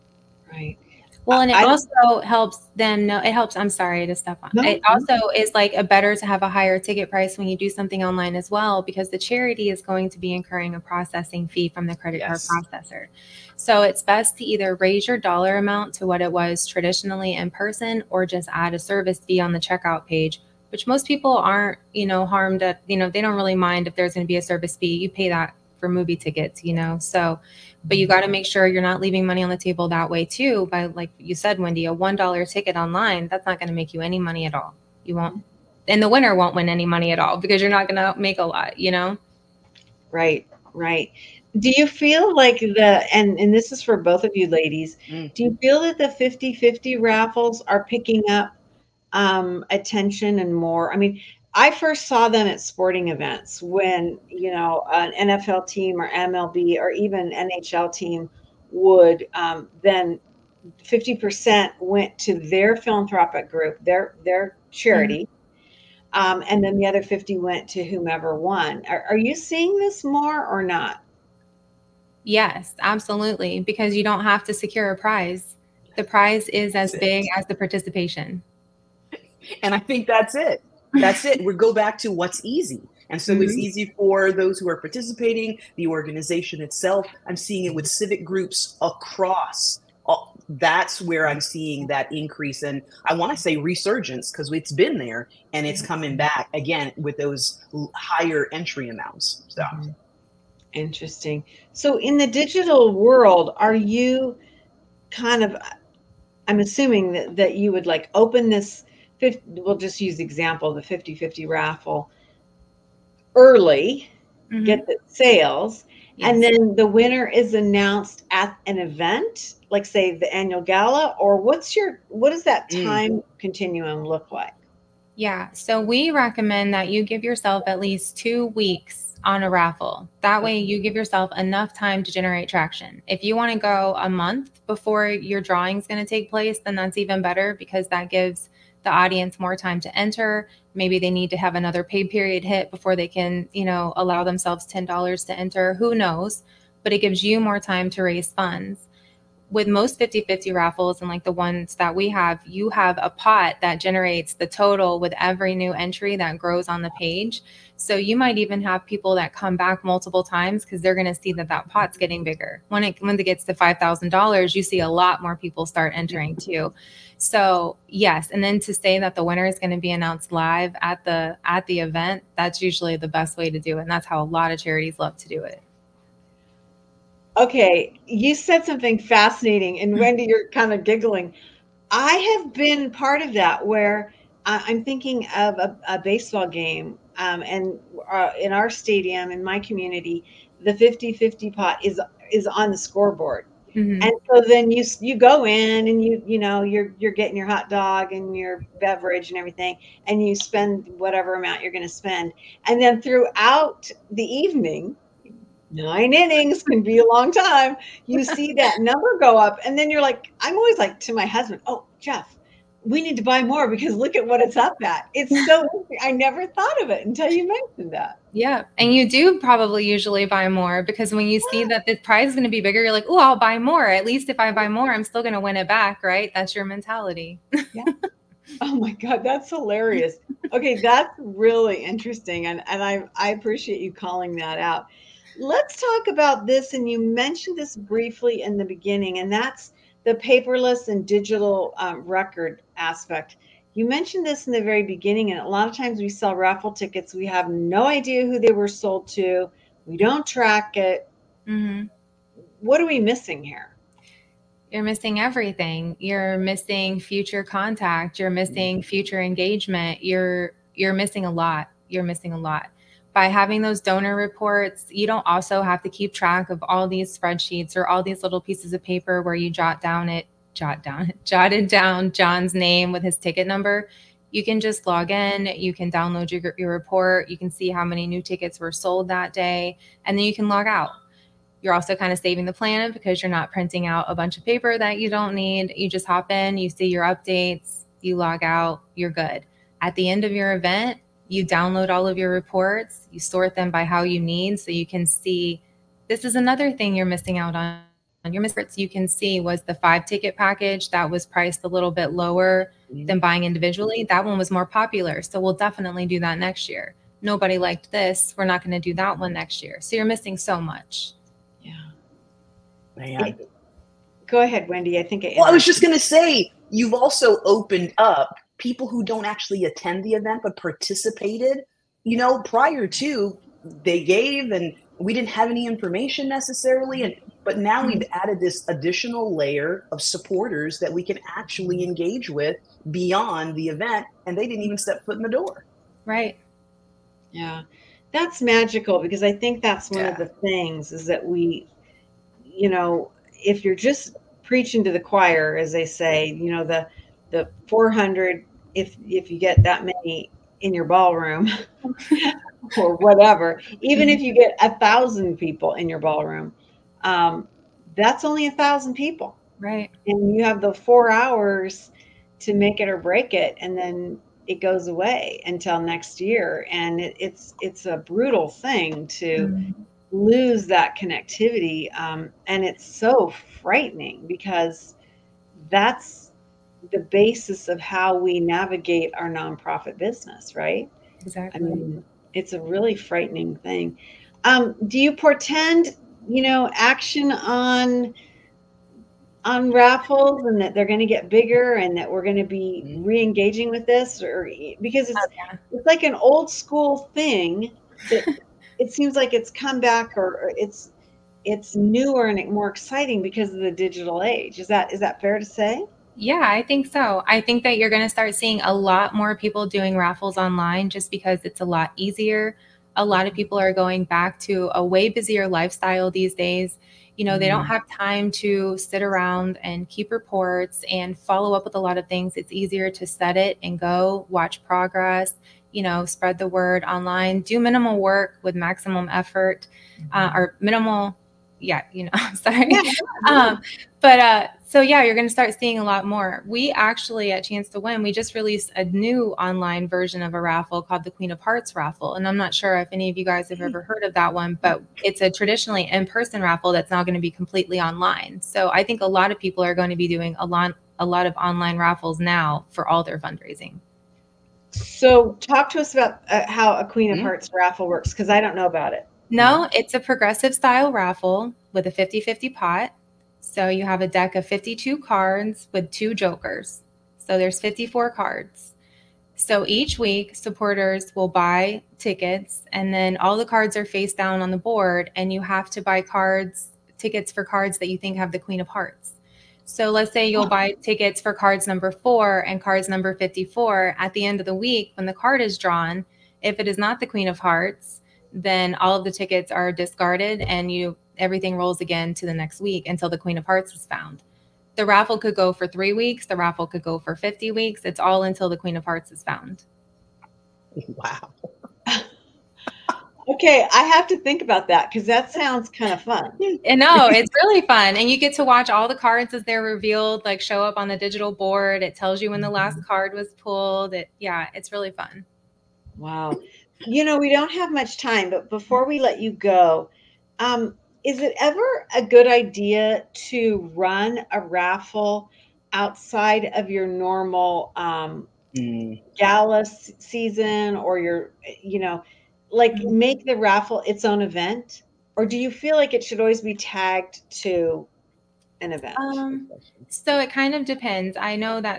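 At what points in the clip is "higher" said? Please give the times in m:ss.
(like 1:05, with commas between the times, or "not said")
0:06, 1:37.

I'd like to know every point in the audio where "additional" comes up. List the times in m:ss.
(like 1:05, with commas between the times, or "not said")
5:28.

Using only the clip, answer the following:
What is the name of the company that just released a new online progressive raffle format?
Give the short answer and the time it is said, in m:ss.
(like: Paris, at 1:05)
Chance to Win, at 7:17.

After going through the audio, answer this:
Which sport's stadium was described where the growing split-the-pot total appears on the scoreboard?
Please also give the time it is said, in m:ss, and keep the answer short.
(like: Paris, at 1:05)
Baseball, at 3:05.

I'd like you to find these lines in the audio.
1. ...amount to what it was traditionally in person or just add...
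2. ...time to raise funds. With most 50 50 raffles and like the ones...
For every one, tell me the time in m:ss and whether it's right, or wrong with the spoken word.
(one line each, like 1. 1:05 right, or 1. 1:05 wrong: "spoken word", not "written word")
1. 0:15 right
2. 2:27 right.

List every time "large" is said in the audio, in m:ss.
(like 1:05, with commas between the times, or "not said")
not said.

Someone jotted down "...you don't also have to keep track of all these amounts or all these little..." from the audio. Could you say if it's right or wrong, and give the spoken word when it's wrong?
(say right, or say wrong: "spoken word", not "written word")
wrong: "spreadsheets", not "amounts".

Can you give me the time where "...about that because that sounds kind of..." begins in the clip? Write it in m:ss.
8:24.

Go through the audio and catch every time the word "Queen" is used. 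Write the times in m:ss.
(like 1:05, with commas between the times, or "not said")
7:21, 7:36, 7:58, 8:07, 8:13, 8:18.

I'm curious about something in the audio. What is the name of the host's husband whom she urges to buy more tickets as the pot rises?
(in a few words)
Jeff.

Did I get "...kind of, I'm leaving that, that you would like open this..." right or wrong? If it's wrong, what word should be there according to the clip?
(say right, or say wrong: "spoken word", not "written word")
wrong: "assuming", not "leaving".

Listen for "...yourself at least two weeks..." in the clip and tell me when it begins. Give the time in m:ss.
2:07.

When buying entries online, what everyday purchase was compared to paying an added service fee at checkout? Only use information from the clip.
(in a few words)
Movie tickets.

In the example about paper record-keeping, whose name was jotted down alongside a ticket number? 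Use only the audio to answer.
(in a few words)
John.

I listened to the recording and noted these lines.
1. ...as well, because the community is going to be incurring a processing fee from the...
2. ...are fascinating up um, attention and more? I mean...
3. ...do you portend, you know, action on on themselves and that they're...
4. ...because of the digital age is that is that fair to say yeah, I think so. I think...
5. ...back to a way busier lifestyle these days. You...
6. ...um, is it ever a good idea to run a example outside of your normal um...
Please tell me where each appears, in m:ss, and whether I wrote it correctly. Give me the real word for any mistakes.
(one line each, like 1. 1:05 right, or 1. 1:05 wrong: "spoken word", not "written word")
1. 0:08 wrong: "charity", not "community"
2. 0:47 wrong: "picking", not "fascinating"
3. 6:24 wrong: "raffles", not "themselves"
4. 6:43 right
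5. 6:54 right
6. 8:40 wrong: "raffle", not "example".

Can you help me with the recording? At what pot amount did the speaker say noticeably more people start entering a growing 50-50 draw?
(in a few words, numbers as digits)
$5,000.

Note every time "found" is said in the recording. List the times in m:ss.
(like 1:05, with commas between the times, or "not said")
8:13, 8:19.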